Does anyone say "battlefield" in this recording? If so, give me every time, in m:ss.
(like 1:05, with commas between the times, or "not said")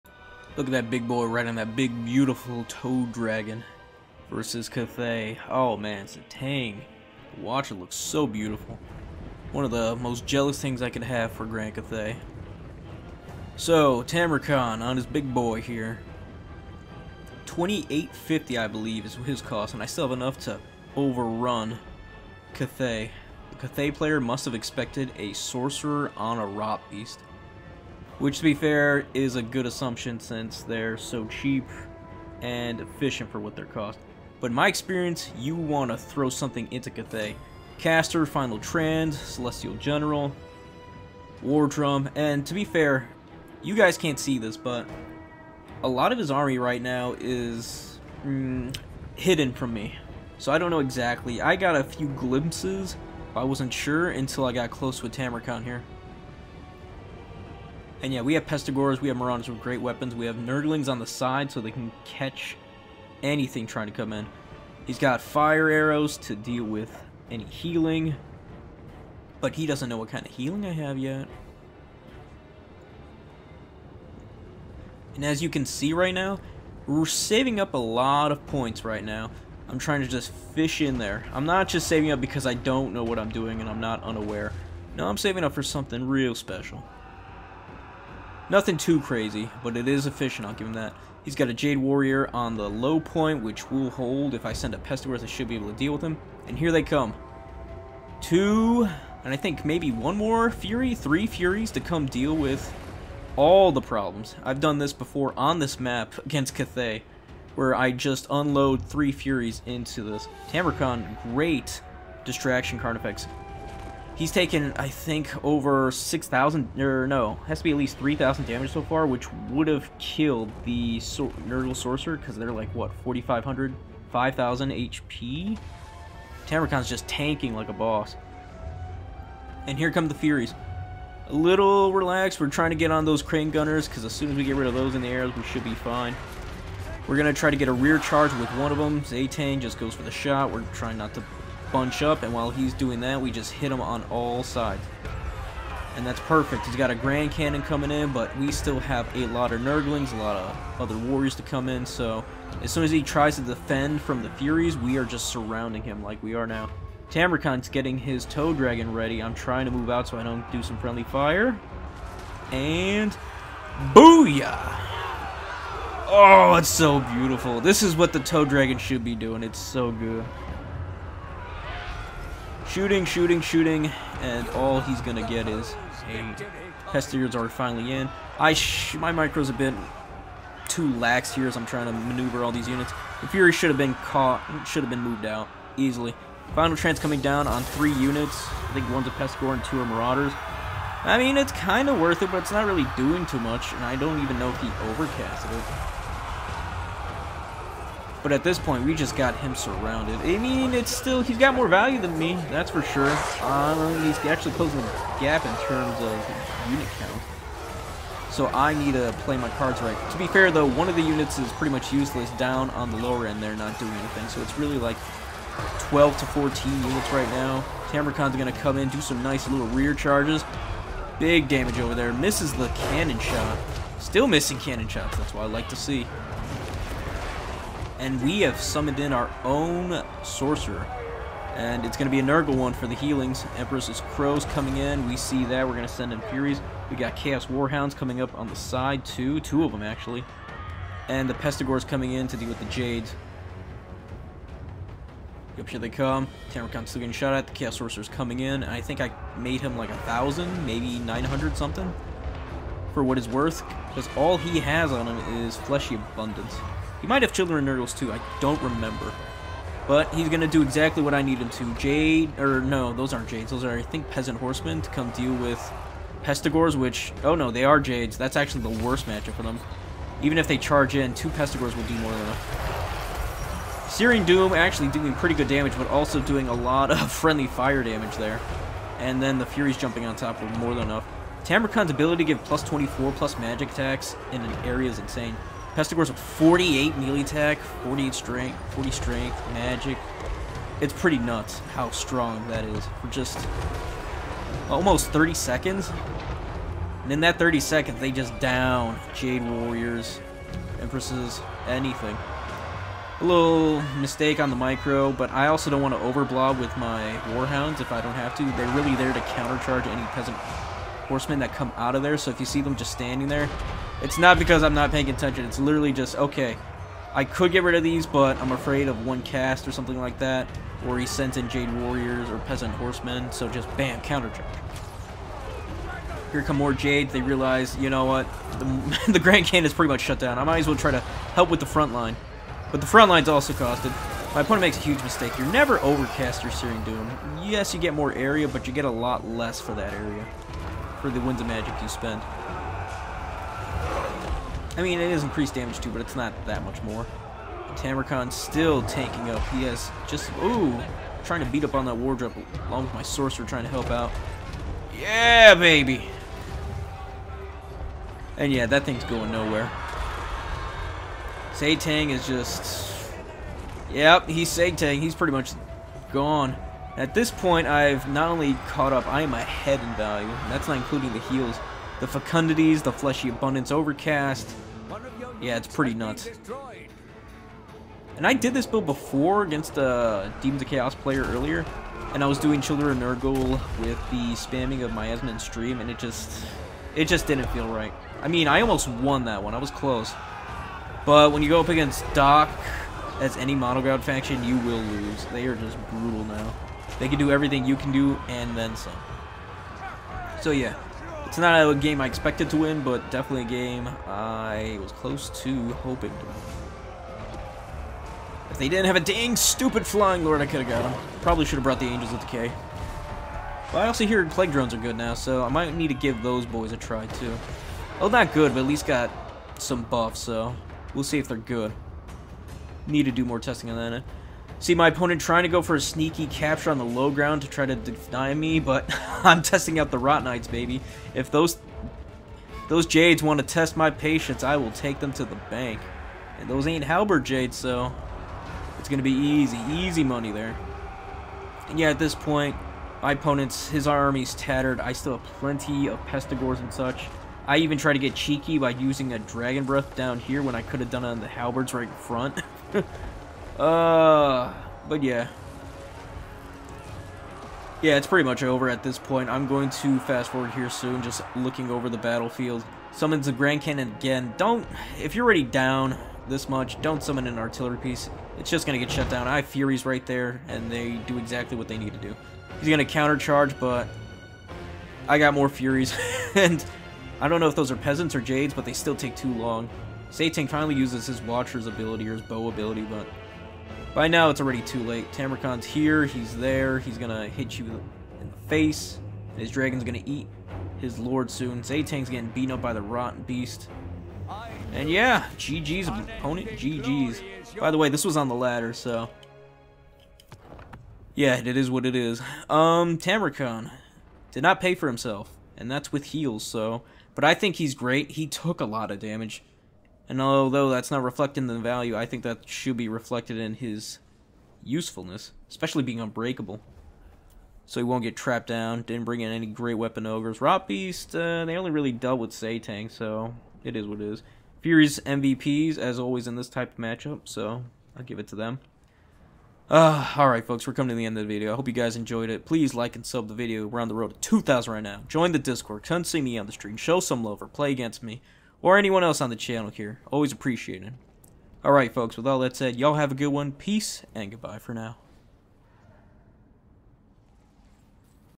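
7:41.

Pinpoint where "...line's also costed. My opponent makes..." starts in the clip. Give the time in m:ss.
5:33.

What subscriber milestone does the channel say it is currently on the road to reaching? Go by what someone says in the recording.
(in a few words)
2,000.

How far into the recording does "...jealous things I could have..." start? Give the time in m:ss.
0:10.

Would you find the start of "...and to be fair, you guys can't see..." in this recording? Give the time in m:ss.
0:42.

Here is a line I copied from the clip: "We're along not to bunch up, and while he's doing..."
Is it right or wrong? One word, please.
wrong.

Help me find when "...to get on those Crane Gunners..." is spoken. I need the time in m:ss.
2:12.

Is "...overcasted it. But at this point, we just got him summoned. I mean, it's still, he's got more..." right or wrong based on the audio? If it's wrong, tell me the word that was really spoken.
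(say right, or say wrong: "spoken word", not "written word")
wrong: "surrounded", not "summoned".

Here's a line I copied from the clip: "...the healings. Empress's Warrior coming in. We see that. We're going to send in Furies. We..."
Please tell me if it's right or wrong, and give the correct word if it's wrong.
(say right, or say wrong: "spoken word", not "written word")
wrong: "Crows", not "Warrior".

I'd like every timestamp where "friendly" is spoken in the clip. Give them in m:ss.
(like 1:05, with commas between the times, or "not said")
2:40, 4:37.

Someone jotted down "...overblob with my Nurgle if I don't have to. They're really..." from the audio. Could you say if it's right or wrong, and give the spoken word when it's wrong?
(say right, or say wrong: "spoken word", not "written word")
wrong: "Warhounds", not "Nurgle".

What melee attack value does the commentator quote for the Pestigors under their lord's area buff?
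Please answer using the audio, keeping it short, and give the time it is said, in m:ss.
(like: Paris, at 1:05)
48, at 4:46.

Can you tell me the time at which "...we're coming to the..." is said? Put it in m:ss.
8:50.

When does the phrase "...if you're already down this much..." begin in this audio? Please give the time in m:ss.
7:45.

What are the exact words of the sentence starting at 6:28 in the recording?
I mean, I almost won that one.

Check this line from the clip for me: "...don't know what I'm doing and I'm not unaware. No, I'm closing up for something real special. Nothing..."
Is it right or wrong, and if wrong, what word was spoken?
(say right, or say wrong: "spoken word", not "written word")
wrong: "saving", not "closing".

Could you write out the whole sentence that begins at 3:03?
The Fury should have been caught, should have been moved out easily.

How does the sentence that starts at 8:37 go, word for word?
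So he won't get trapped down.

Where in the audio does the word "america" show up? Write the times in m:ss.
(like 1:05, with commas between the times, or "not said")
not said.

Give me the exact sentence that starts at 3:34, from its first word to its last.
So it's really like 12 to 14 units right now.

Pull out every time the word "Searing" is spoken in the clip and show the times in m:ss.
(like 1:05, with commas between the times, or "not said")
4:33, 5:36.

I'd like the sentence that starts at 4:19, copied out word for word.
But he's going to do exactly what I need him to.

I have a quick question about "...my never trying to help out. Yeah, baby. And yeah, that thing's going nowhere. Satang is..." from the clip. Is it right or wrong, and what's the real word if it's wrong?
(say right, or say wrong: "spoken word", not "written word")
wrong: "sorcerer", not "never".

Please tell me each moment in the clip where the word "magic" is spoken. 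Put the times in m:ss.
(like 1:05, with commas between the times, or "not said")
4:43, 4:49, 5:41.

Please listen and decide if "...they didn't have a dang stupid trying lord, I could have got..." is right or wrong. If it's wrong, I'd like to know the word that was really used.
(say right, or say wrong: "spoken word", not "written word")
wrong: "flying", not "trying".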